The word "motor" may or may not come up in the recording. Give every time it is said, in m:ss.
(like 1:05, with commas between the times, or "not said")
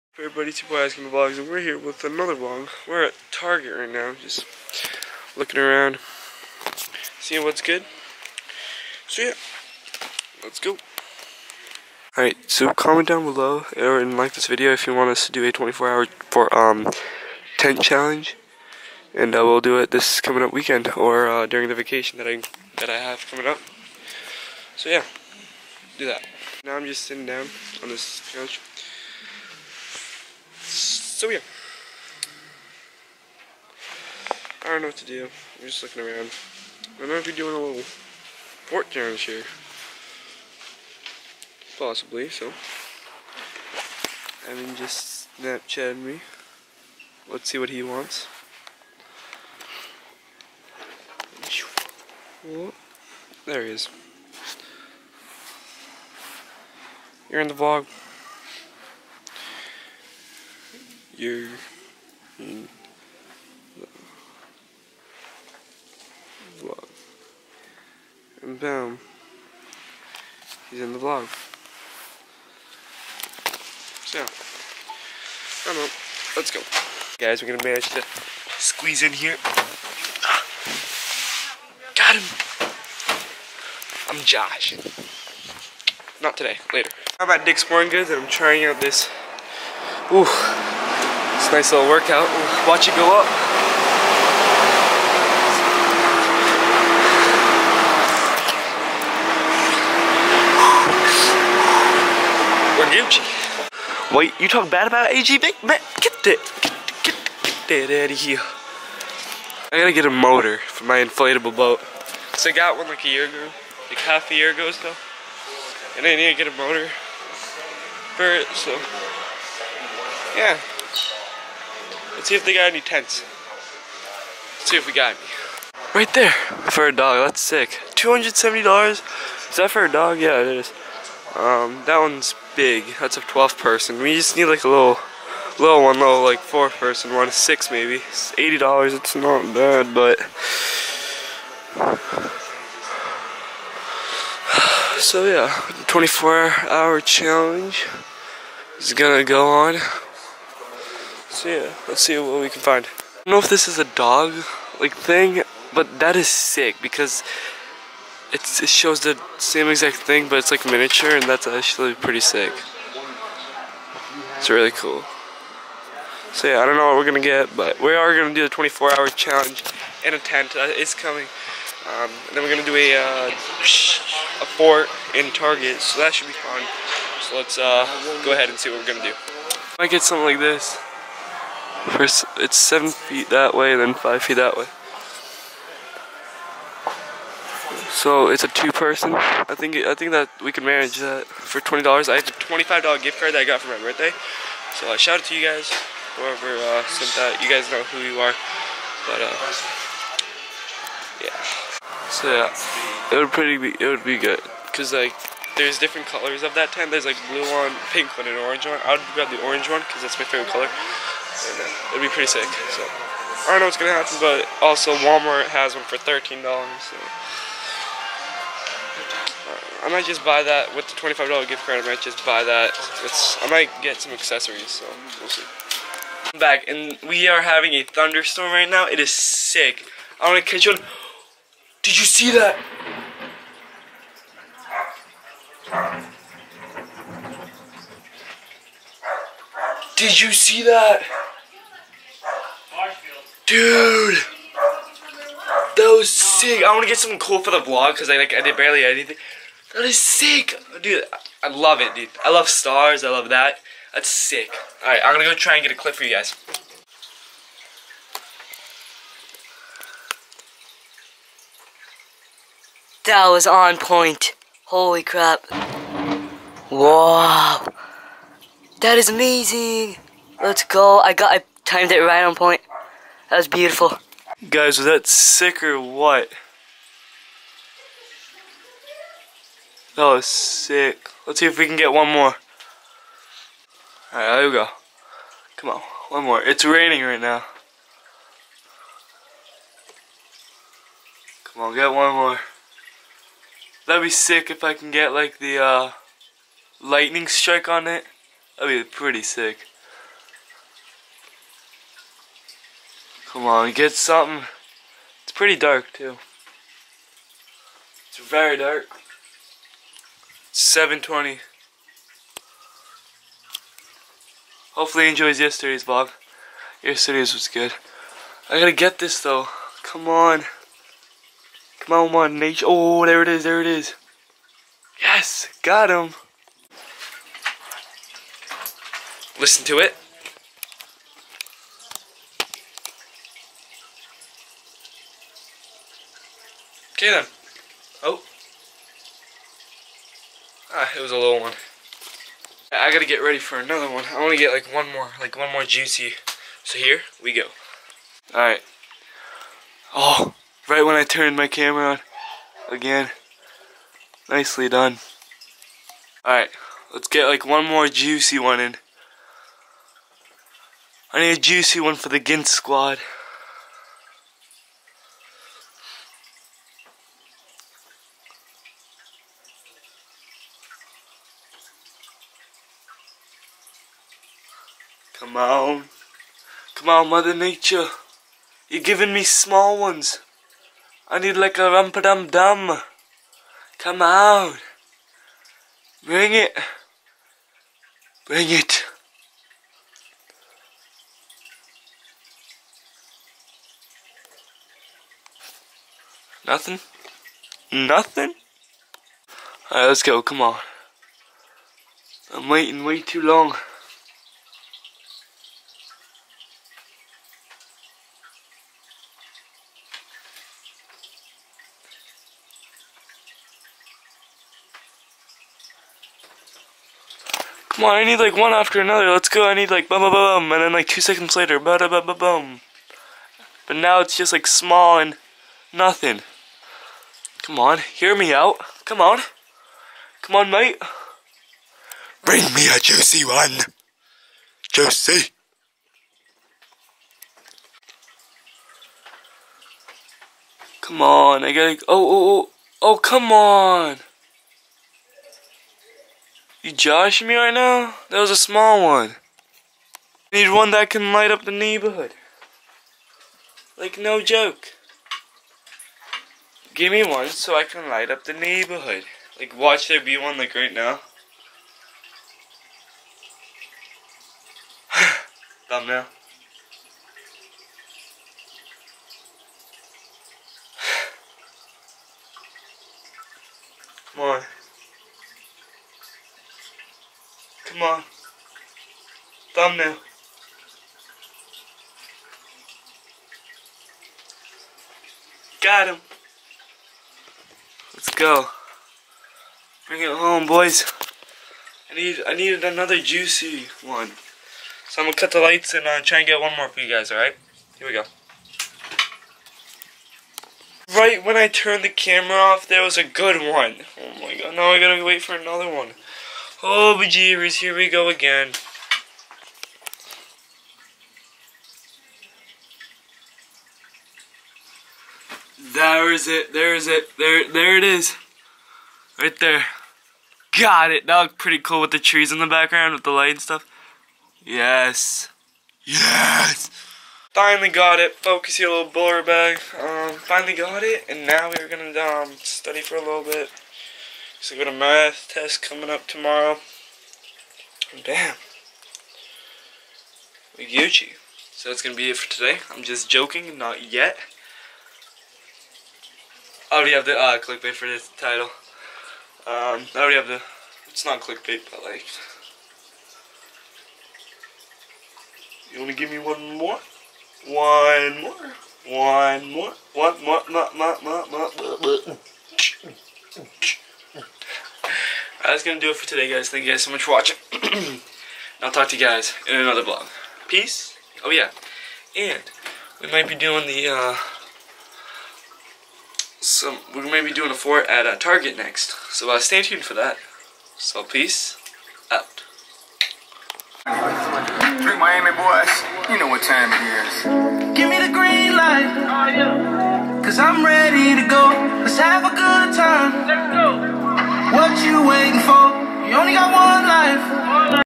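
1:50, 1:56.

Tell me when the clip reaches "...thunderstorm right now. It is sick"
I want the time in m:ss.
3:47.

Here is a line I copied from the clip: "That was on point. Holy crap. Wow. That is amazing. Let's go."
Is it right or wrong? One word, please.
right.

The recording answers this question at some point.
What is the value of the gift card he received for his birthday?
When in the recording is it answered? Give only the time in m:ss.
3:12.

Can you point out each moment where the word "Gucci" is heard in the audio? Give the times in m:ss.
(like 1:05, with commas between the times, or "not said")
1:43, 9:00.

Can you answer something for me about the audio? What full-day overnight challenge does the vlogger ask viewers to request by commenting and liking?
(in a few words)
24-hour tent challenge.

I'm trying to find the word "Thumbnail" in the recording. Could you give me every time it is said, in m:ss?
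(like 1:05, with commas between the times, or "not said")
7:45, 7:59.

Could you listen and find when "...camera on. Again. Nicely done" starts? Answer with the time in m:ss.
5:51.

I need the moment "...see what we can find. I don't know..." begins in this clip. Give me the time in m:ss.
2:32.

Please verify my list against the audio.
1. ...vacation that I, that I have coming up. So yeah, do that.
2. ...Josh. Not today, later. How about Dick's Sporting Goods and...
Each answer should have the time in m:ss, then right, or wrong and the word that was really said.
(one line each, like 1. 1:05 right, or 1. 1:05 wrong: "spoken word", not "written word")
1. 0:21 right
2. 1:24 right.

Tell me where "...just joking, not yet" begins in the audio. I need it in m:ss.
9:02.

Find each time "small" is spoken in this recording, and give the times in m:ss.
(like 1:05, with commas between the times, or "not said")
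6:19, 7:04, 7:28.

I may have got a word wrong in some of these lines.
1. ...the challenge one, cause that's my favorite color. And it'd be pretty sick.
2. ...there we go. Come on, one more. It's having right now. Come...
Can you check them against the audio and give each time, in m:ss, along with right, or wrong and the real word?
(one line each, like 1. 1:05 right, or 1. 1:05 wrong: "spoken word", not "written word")
1. 3:29 wrong: "orange", not "challenge"
2. 4:44 wrong: "raining", not "having".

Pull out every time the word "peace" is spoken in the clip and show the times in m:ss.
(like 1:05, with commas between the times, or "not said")
9:30, 9:41.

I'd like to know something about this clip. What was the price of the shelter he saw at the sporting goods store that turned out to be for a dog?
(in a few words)
$270.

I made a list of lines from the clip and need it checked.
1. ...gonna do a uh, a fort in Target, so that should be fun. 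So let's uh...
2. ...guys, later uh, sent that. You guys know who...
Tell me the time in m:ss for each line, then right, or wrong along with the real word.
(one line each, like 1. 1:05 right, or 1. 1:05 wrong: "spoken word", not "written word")
1. 2:52 right
2. 3:15 wrong: "whoever", not "later".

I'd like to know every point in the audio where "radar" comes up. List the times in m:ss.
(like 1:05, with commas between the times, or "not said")
not said.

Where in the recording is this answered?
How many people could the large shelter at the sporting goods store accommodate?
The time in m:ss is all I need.
2:13.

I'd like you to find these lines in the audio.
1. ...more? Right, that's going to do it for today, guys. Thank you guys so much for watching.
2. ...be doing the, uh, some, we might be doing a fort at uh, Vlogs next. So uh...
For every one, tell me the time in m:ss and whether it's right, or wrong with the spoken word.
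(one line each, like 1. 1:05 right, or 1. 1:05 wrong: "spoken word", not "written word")
1. 9:23 right
2. 9:33 wrong: "Target", not "Vlogs".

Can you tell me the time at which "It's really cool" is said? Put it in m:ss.
2:44.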